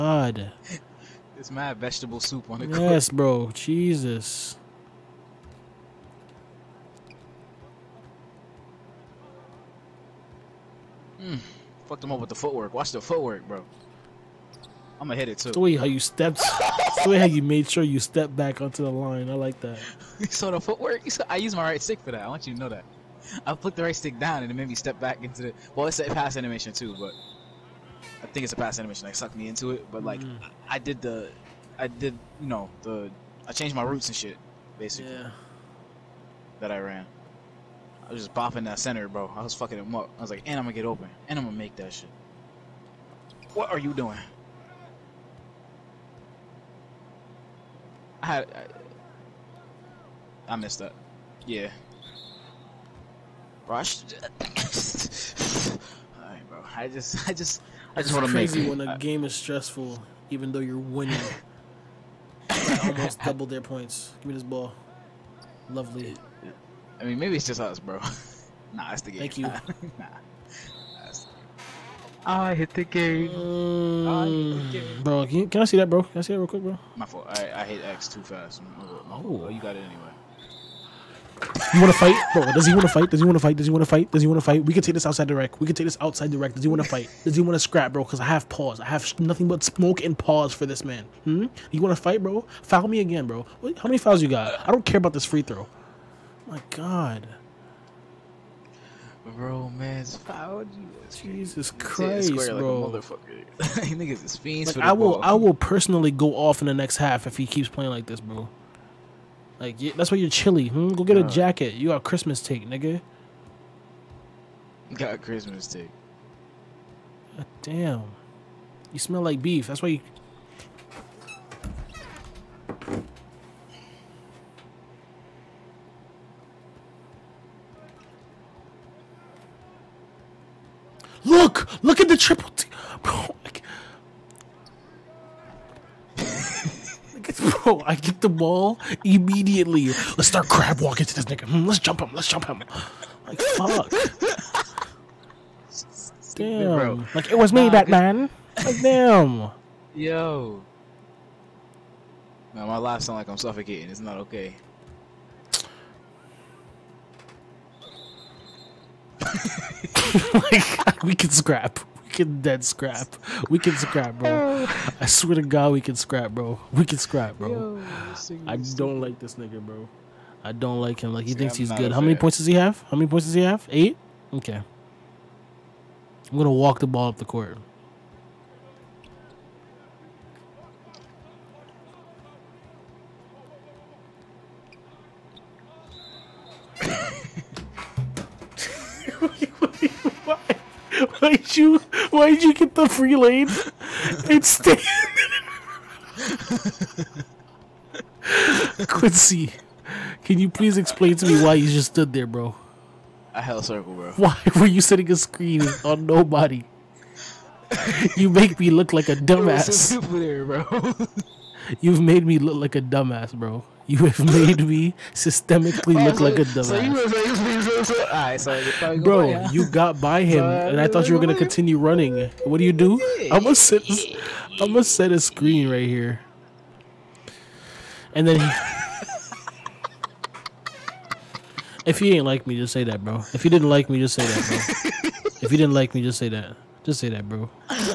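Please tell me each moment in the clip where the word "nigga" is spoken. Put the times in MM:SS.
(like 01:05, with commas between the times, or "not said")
01:52, 02:21, 02:49.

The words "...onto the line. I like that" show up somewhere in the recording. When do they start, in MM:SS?
00:18.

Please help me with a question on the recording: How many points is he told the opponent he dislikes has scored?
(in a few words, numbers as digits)
8.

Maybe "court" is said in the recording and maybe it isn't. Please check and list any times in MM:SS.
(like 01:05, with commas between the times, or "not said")
00:02, 02:57.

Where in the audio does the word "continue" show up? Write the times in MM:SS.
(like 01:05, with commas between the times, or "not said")
03:41.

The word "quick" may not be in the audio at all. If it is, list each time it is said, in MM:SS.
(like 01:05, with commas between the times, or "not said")
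01:16.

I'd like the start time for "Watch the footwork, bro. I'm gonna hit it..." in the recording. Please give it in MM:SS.
00:12.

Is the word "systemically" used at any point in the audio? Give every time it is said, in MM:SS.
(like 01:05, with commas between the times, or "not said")
03:35.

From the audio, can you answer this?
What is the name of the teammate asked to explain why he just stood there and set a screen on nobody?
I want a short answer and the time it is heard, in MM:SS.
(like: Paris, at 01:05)
Quincy, at 03:18.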